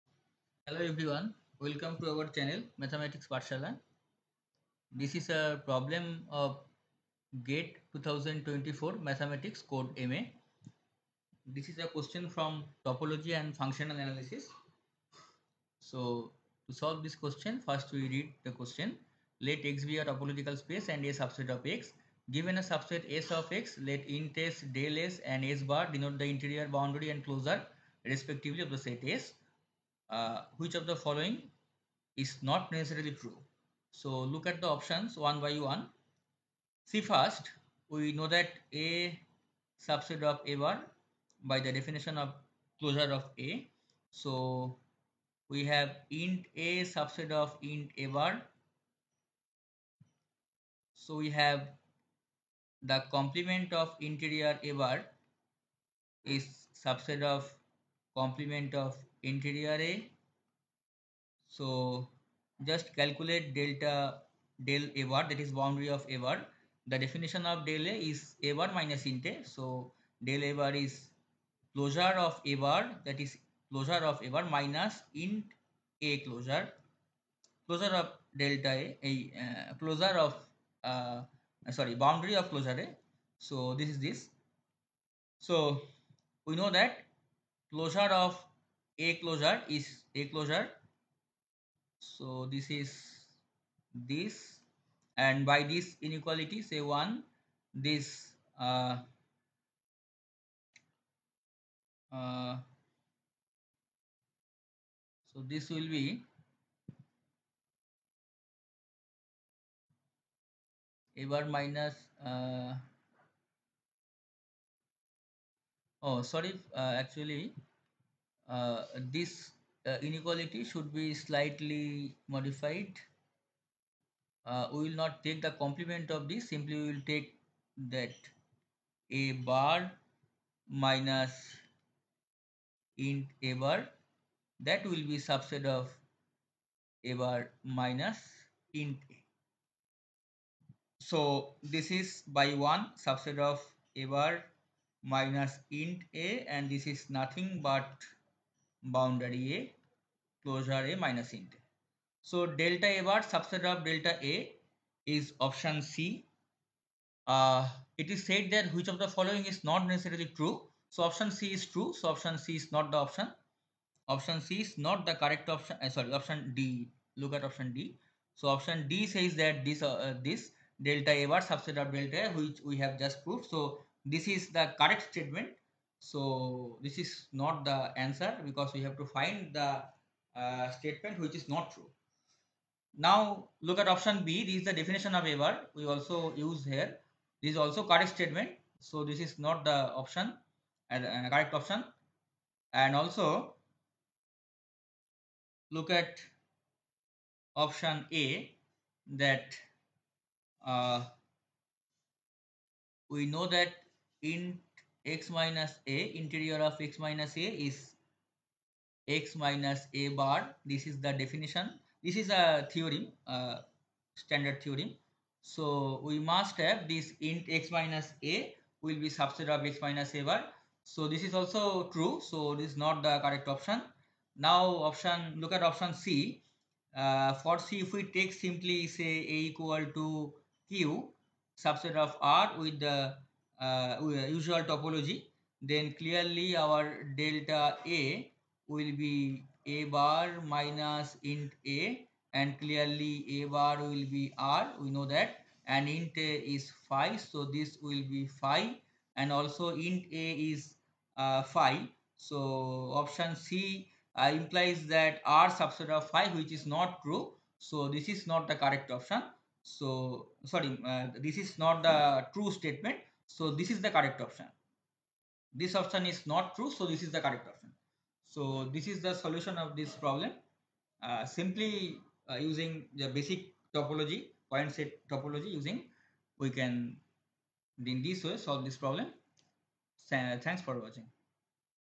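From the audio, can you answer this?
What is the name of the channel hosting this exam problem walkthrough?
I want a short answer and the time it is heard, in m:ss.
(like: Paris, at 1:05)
Mathematics Pathshala, at 0:02.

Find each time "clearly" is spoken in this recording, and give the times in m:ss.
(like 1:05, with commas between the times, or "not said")
3:55, 4:02.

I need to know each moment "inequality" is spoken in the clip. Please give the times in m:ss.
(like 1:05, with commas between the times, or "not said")
1:36, 2:00.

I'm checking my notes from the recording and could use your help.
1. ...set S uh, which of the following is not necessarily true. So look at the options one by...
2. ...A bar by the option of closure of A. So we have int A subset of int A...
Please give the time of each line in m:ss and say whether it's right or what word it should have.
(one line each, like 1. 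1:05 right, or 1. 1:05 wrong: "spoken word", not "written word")
1. 0:28 right
2. 0:40 wrong: "definition", not "option".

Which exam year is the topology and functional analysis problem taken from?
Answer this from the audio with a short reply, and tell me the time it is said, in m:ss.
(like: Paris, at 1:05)
2024, at 0:07.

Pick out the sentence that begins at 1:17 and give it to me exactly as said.
Closure of delta A, a uh, closure of uh, sorry boundary of closure A.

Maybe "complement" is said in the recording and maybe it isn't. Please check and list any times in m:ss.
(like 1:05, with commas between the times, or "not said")
0:53, 0:58, 2:05.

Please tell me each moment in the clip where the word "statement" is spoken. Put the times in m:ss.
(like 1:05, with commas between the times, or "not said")
2:55, 3:00, 3:08, 4:22.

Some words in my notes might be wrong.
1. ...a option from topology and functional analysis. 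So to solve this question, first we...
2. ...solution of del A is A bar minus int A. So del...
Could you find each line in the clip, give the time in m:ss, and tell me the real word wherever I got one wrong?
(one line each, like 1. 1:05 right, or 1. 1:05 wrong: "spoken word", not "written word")
1. 0:11 wrong: "question", not "option"
2. 1:06 wrong: "definition", not "solution".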